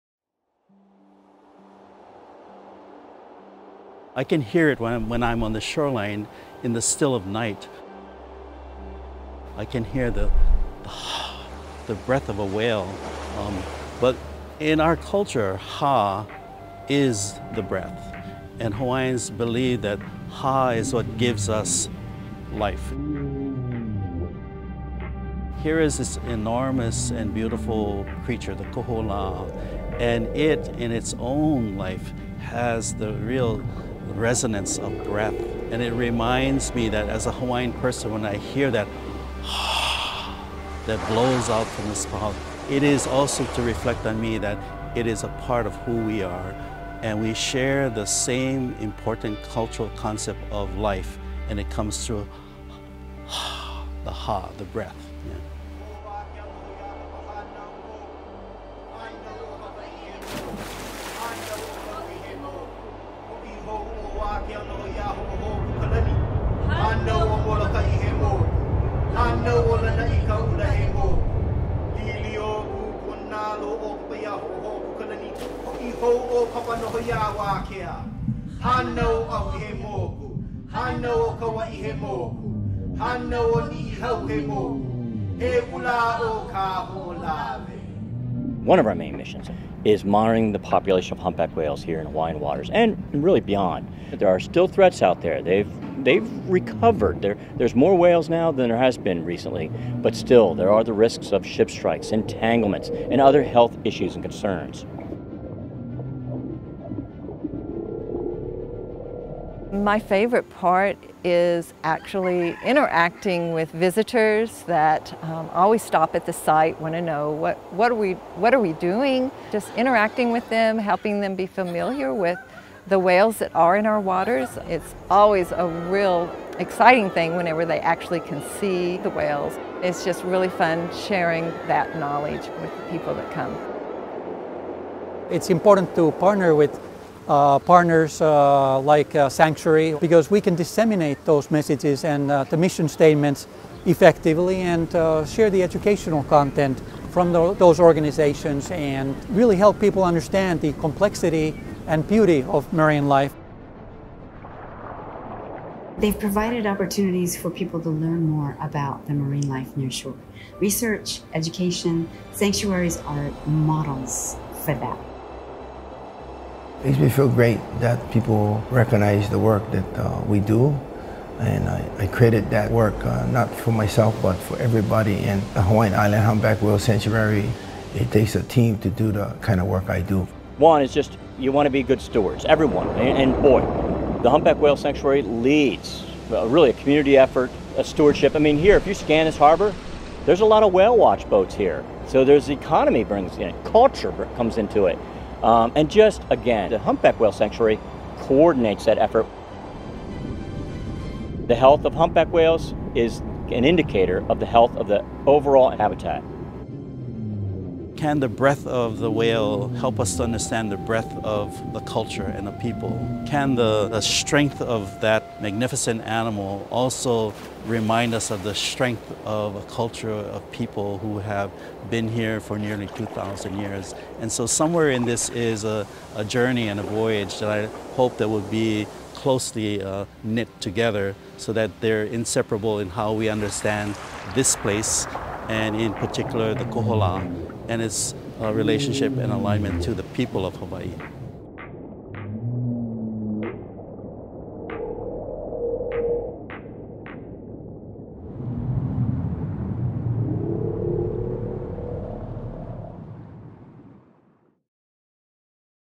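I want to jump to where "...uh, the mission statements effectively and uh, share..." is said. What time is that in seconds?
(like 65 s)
142 s.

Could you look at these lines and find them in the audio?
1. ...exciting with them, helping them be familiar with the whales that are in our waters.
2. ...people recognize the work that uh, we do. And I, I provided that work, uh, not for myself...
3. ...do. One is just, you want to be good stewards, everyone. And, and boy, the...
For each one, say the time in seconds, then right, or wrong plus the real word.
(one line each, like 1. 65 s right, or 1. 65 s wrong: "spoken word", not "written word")
1. 119 s wrong: "interacting", not "exciting"
2. 168 s wrong: "created", not "provided"
3. 180 s right.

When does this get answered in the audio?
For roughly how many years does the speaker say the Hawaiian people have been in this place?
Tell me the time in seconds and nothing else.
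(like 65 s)
222 s.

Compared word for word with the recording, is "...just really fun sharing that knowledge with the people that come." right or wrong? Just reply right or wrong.
right.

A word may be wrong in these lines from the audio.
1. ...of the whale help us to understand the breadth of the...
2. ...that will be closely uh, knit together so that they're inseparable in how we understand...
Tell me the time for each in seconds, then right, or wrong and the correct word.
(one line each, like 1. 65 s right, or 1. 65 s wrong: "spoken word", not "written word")
1. 208 s right
2. 228 s right.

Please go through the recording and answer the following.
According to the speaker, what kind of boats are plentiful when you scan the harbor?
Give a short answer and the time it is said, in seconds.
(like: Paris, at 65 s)
whale watch boats, at 190 s.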